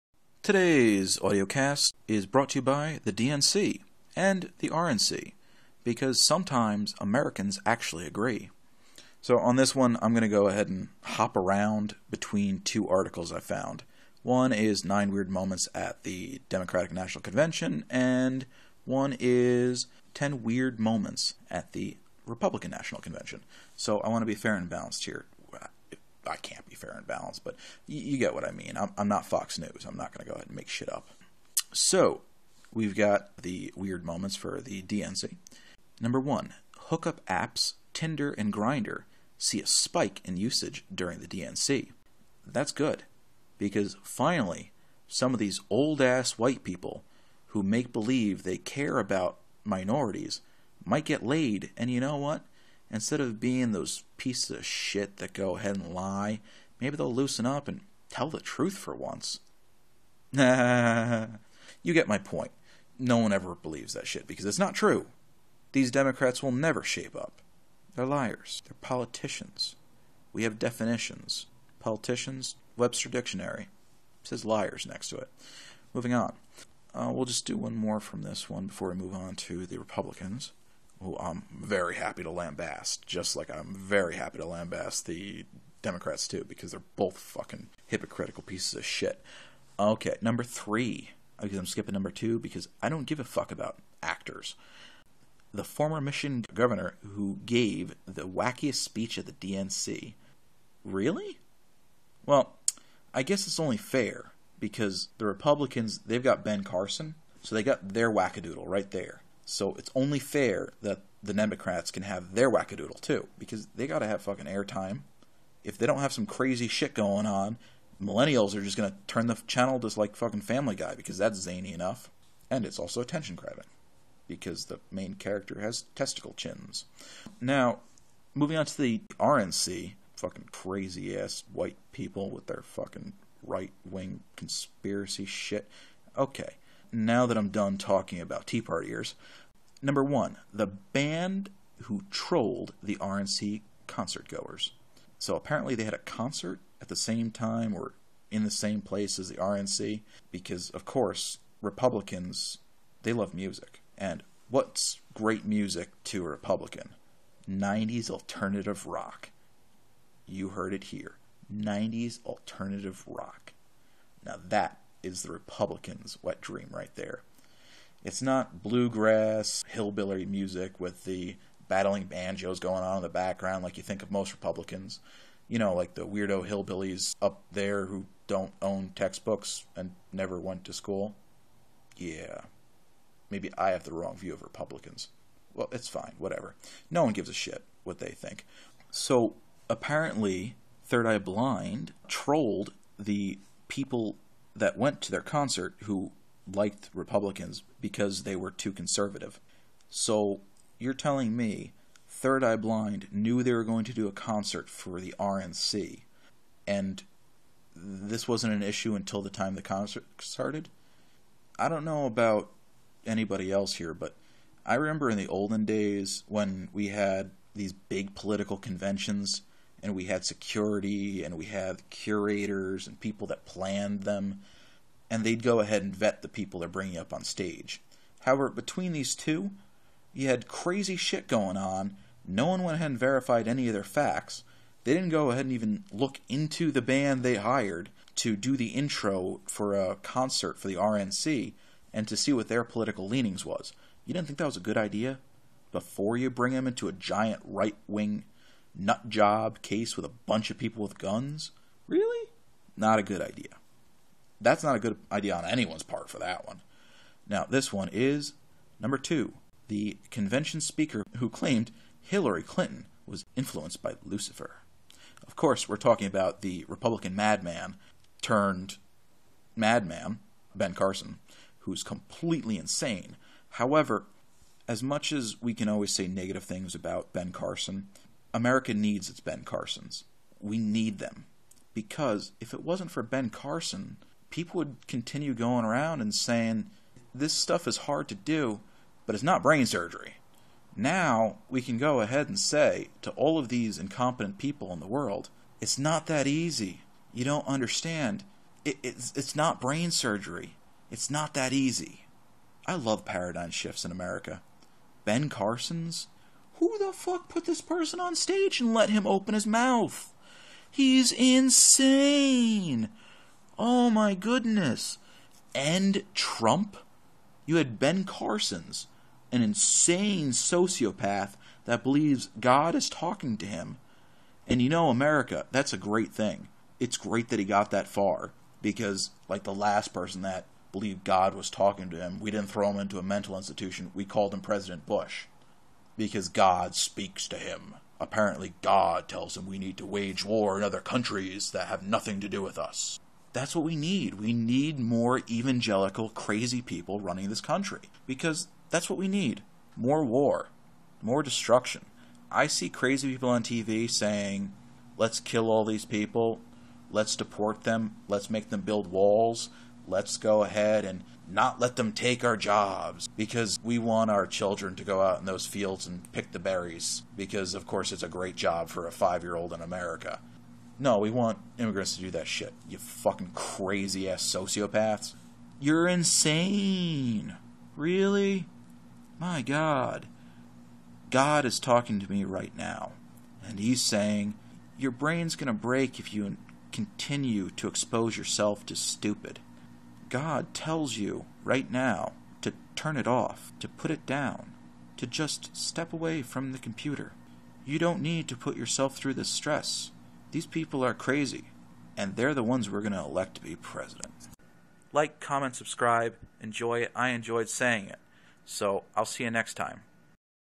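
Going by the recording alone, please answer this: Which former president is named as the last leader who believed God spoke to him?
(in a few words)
President Bush.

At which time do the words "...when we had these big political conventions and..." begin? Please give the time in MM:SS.
03:36.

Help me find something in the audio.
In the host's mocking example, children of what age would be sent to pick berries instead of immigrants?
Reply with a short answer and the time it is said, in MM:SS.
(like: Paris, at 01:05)
5, at 06:08.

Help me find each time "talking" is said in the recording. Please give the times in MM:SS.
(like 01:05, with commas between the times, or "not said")
02:17, 04:25, 05:22, 05:31, 06:21.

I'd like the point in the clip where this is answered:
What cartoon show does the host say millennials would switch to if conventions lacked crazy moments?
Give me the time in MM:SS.
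02:00.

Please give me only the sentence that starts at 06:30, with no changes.
God tells you right now to turn it off, to put it down, to just step away from the computer.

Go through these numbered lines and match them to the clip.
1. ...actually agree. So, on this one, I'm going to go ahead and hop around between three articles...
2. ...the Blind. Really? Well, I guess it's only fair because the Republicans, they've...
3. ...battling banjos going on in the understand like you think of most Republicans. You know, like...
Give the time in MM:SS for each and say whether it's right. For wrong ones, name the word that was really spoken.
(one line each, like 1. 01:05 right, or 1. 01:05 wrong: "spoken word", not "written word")
1. 00:07 wrong: "two", not "three"
2. 01:39 wrong: "DNC", not "Blind"
3. 02:51 wrong: "background", not "understand".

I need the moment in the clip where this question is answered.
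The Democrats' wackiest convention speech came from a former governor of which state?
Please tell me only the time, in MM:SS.
01:35.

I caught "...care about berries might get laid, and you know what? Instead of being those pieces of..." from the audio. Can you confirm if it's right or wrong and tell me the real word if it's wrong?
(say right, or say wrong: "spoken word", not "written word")
wrong: "minorities", not "berries".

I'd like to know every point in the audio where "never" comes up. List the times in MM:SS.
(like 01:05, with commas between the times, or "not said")
01:06, 03:00.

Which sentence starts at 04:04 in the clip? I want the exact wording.
You didn't think that was a good idea?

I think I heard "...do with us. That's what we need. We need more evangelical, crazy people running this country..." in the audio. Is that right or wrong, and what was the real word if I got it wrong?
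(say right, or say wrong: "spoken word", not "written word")
right.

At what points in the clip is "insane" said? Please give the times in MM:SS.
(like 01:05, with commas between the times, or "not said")
04:32, 05:11, 05:19, 06:15.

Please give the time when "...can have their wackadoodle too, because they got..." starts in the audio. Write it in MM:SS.
01:51.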